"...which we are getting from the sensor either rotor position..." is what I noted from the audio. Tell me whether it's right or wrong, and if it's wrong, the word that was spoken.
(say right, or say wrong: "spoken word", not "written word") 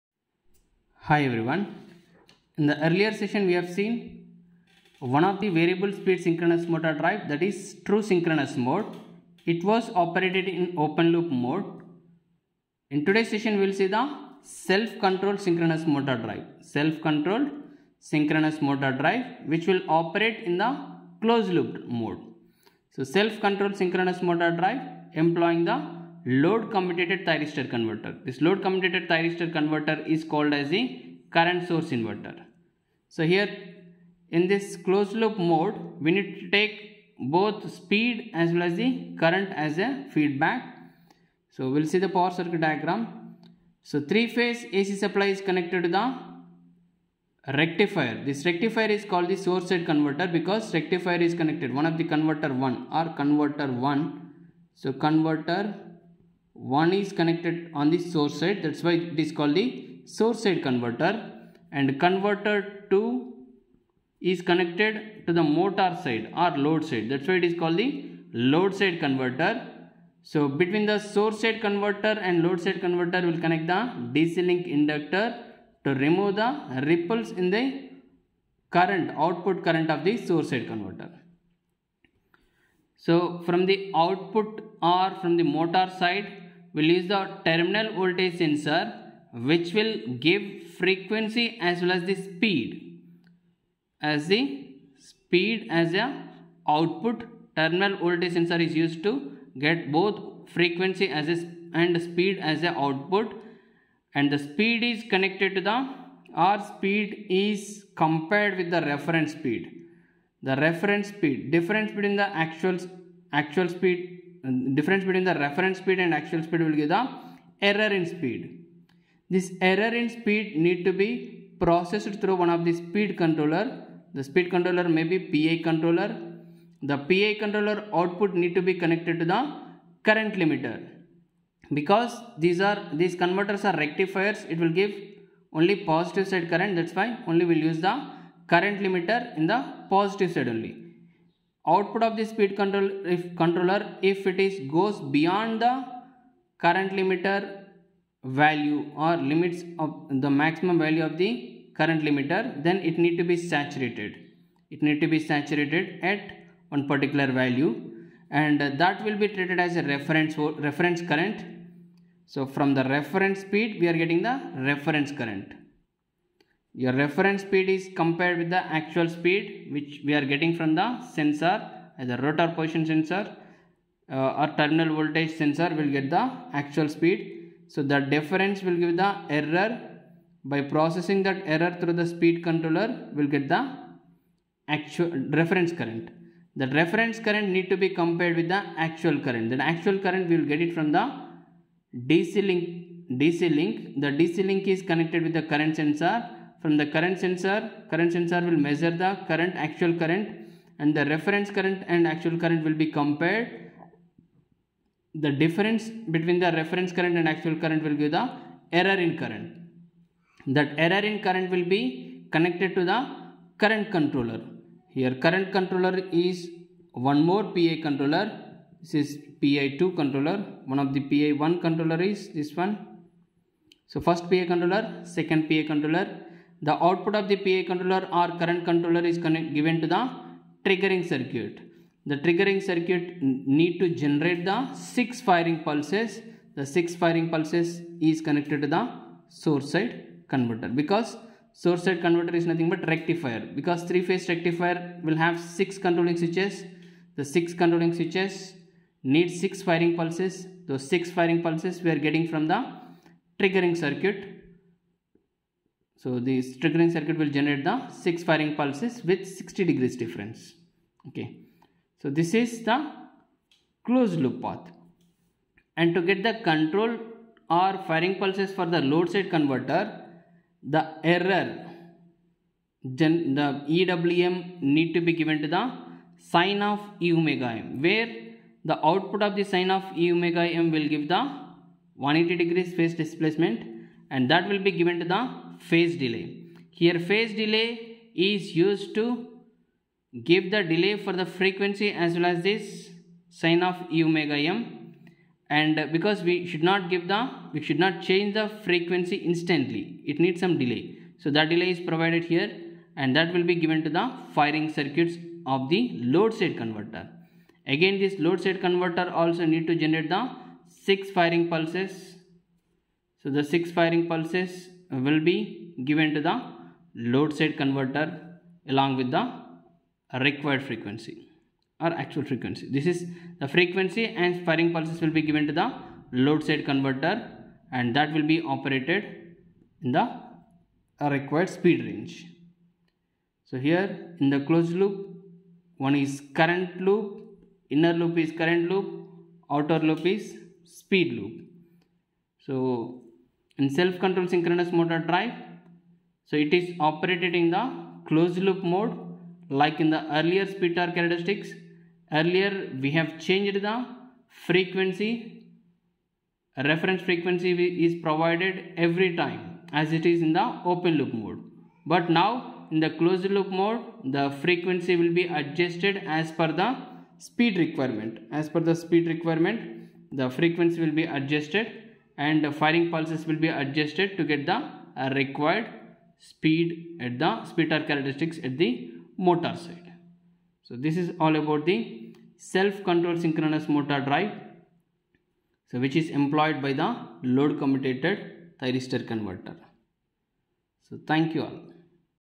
right.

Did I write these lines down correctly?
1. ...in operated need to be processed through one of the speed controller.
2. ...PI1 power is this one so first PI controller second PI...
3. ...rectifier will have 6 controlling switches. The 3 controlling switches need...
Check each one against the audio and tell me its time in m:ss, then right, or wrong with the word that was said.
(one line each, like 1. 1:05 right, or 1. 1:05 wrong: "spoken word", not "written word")
1. 1:59 wrong: "speed", not "operated"
2. 3:41 wrong: "controller", not "power"
3. 4:04 wrong: "6", not "3".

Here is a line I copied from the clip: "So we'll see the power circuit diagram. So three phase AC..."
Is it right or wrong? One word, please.
right.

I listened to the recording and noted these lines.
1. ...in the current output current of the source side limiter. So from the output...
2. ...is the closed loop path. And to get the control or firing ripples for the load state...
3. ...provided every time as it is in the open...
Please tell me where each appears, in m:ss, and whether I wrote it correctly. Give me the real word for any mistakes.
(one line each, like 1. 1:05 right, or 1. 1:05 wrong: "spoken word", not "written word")
1. 1:17 wrong: "converter", not "limiter"
2. 4:22 wrong: "pulses", not "ripples"
3. 5:58 right.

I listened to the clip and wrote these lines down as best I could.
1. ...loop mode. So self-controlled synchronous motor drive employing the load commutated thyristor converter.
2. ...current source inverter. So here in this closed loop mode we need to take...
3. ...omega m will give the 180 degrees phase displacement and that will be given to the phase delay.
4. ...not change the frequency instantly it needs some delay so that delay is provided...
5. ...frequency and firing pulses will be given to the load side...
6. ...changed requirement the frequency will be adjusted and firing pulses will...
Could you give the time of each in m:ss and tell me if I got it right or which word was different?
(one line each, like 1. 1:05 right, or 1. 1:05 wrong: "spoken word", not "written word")
1. 0:21 right
2. 0:31 right
3. 4:40 right
4. 4:57 right
5. 5:23 right
6. 6:08 wrong: "speed", not "changed".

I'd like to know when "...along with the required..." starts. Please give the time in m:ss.
5:18.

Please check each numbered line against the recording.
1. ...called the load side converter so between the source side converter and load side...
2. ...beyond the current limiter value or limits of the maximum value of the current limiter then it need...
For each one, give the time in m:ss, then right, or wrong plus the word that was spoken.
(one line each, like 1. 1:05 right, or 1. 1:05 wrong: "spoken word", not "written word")
1. 1:07 right
2. 2:25 right.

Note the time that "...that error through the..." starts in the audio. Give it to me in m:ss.
3:01.